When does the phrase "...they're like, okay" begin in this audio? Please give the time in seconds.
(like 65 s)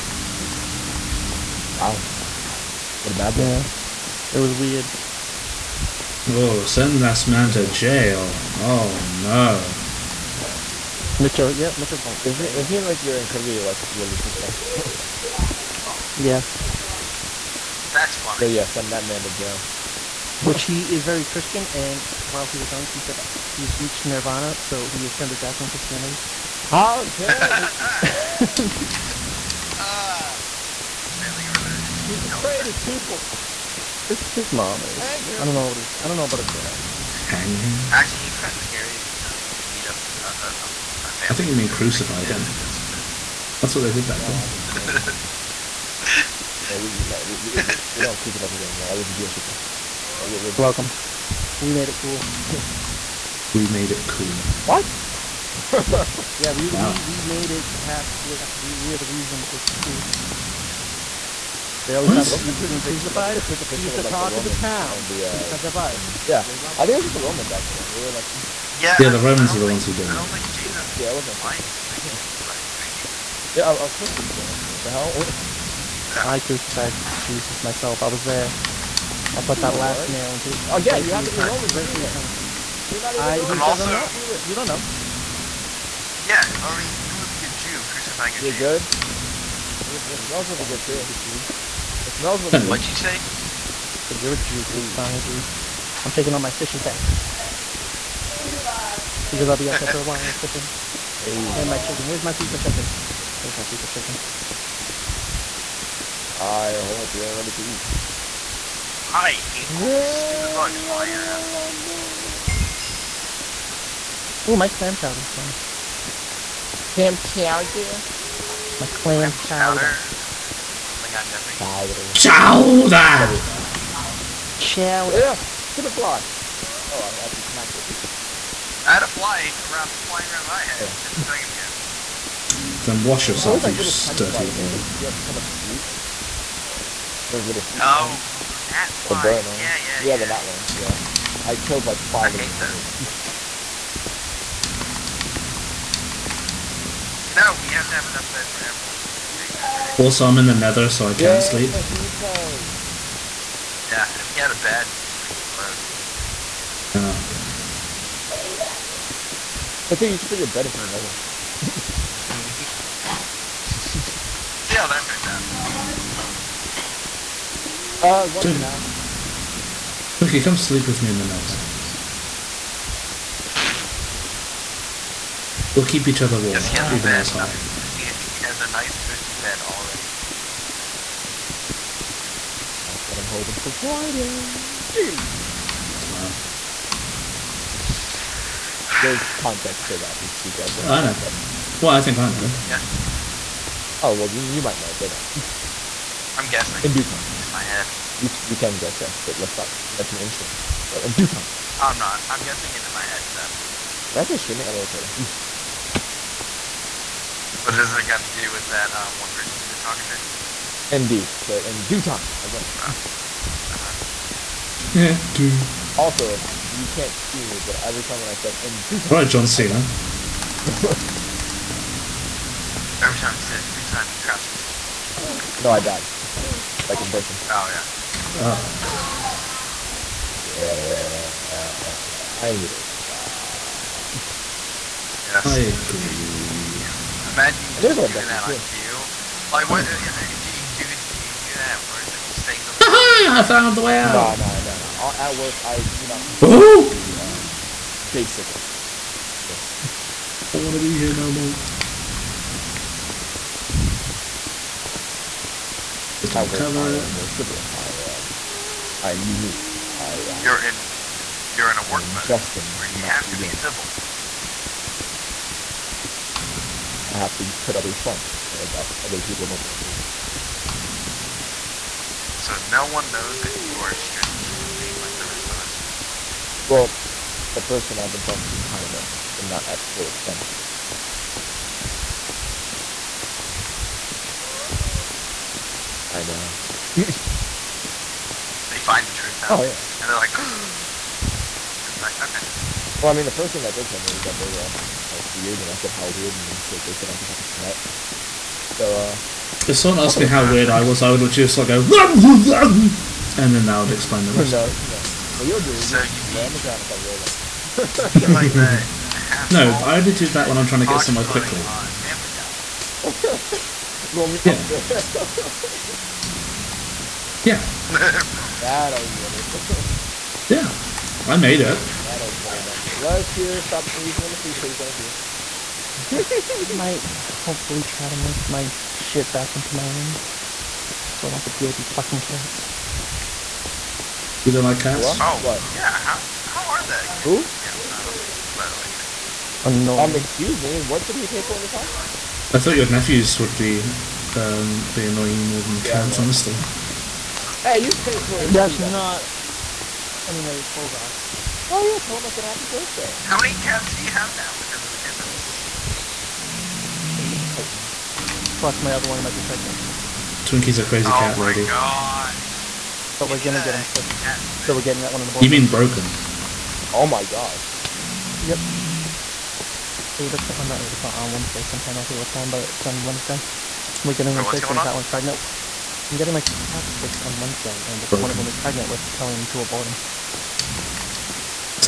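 291 s.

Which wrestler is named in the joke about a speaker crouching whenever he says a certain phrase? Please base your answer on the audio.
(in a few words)
John Cena.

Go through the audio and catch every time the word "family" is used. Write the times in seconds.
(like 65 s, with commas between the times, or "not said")
31 s, 41 s.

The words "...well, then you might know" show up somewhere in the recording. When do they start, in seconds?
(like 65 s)
194 s.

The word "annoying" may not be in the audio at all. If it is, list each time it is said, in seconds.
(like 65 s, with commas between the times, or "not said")
339 s, 345 s.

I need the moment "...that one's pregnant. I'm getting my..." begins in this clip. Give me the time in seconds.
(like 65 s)
374 s.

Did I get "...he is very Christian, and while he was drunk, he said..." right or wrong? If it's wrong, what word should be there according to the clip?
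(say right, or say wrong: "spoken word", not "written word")
right.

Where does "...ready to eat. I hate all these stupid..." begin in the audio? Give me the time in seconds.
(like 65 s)
107 s.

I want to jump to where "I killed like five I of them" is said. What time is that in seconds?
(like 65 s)
141 s.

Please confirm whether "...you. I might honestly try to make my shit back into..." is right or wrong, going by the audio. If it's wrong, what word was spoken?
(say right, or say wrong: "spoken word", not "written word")
wrong: "hopefully", not "honestly".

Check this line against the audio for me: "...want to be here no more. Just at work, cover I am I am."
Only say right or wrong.
right.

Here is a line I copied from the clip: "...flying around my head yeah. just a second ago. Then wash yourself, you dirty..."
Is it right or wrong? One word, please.
right.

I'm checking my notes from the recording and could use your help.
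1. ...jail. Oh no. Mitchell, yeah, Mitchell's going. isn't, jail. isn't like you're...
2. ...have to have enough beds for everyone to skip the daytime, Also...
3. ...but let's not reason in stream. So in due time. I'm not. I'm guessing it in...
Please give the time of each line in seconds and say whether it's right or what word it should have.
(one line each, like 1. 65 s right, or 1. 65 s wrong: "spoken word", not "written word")
1. 7 s right
2. 147 s right
3. 199 s wrong: "mention", not "reason".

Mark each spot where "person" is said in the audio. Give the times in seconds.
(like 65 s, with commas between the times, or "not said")
209 s, 227 s, 277 s.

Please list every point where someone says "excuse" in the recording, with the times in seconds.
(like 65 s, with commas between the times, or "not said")
340 s.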